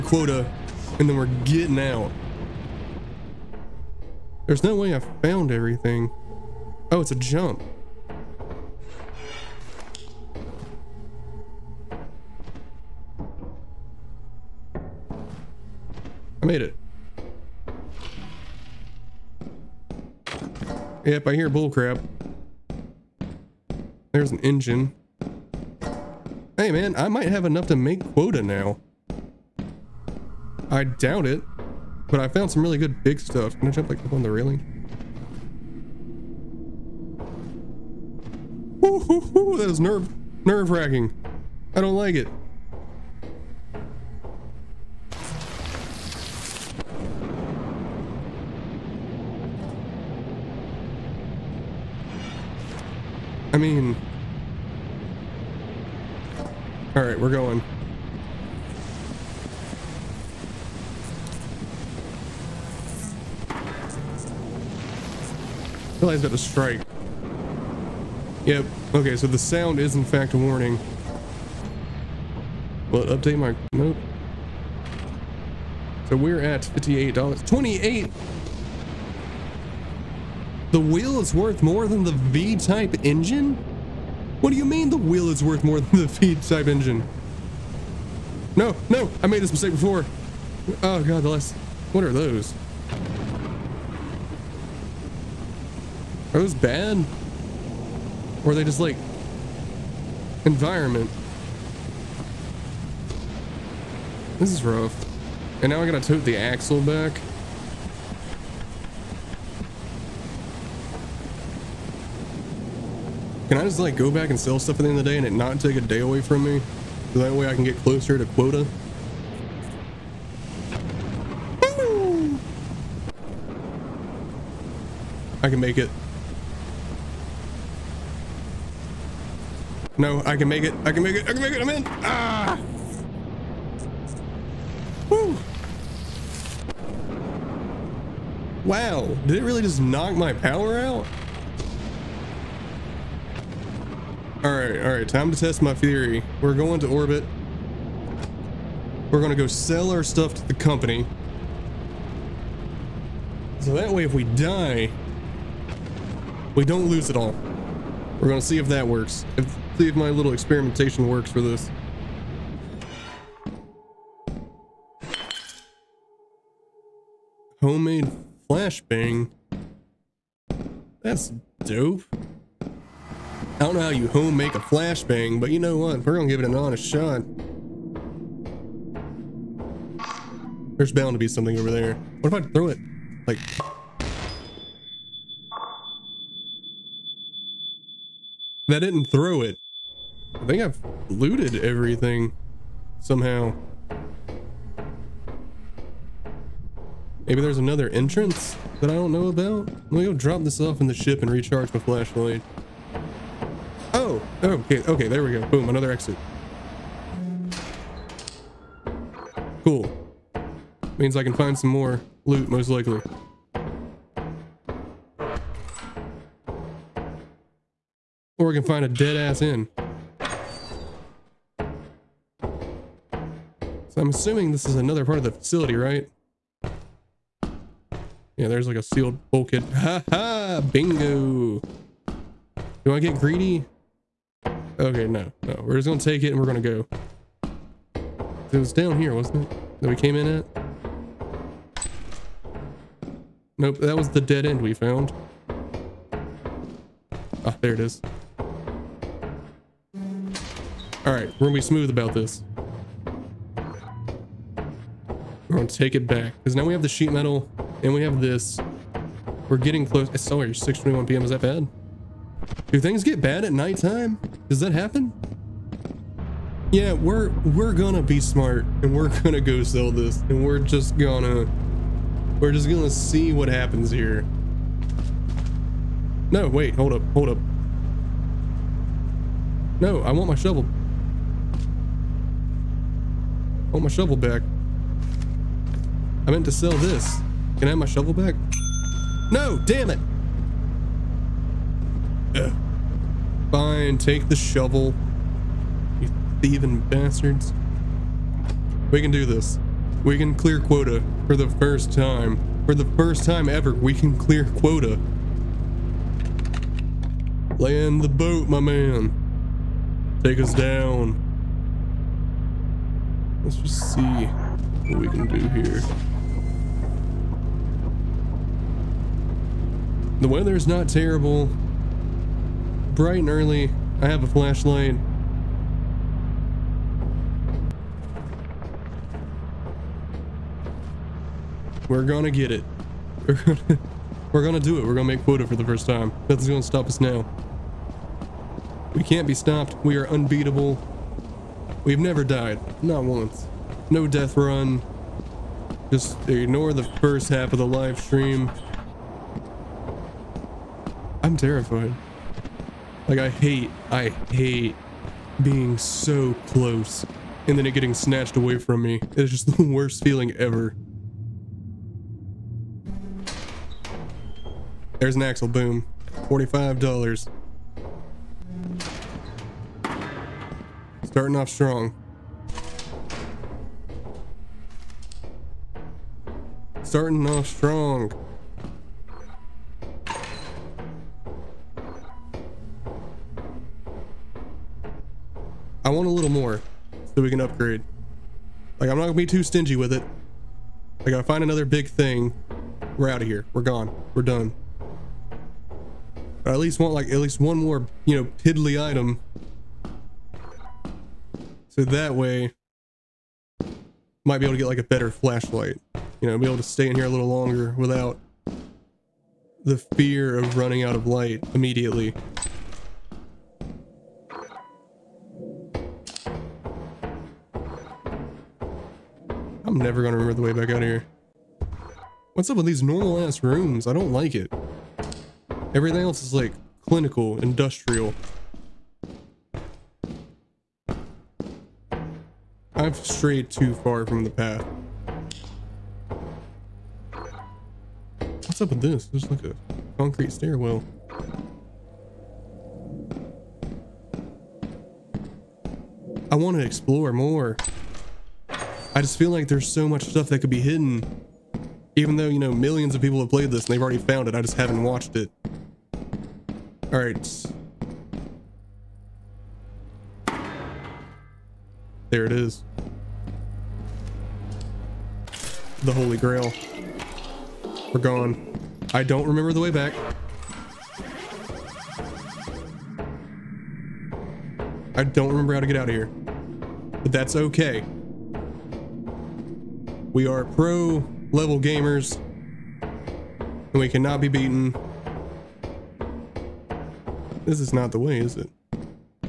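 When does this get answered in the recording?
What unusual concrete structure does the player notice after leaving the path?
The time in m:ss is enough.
7:19.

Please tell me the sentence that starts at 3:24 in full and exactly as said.
Oh, okay, okay, there we go.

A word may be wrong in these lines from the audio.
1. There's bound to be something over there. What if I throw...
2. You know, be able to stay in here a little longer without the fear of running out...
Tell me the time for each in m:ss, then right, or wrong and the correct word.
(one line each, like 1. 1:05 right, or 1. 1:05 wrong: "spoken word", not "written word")
1. 3:00 right
2. 6:46 right.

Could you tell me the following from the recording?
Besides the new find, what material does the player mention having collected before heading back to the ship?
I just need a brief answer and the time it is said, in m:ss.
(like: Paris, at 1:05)
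Sheet metal, at 4:16.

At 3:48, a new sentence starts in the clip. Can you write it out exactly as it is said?
Yeah, there's like a sealed bulkhead.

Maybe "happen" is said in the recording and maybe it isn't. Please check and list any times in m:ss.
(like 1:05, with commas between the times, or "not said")
4:24, 4:33.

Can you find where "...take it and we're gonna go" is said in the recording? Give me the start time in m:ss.
3:55.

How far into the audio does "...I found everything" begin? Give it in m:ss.
0:04.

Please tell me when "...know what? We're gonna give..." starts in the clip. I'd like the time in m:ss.
2:55.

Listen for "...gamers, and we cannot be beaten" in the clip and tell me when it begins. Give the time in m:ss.
8:01.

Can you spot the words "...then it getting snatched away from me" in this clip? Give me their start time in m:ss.
5:57.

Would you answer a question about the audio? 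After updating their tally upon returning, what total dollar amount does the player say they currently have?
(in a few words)
$58.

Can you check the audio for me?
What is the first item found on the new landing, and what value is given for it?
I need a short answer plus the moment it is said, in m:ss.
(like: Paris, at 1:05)
Axle, $45, at 6:05.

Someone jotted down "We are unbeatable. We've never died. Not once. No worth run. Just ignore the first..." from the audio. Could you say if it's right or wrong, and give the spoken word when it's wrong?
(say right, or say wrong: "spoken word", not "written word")
wrong: "death", not "worth".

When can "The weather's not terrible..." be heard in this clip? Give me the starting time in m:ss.
5:20.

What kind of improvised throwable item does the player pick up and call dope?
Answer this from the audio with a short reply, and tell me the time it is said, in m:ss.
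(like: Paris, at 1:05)
Homemade flashbang, at 2:47.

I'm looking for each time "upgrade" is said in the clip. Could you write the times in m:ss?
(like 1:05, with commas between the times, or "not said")
6:27.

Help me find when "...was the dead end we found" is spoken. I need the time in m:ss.
4:03.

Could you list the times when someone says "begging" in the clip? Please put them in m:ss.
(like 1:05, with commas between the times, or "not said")
not said.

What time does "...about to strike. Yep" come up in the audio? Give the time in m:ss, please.
1:06.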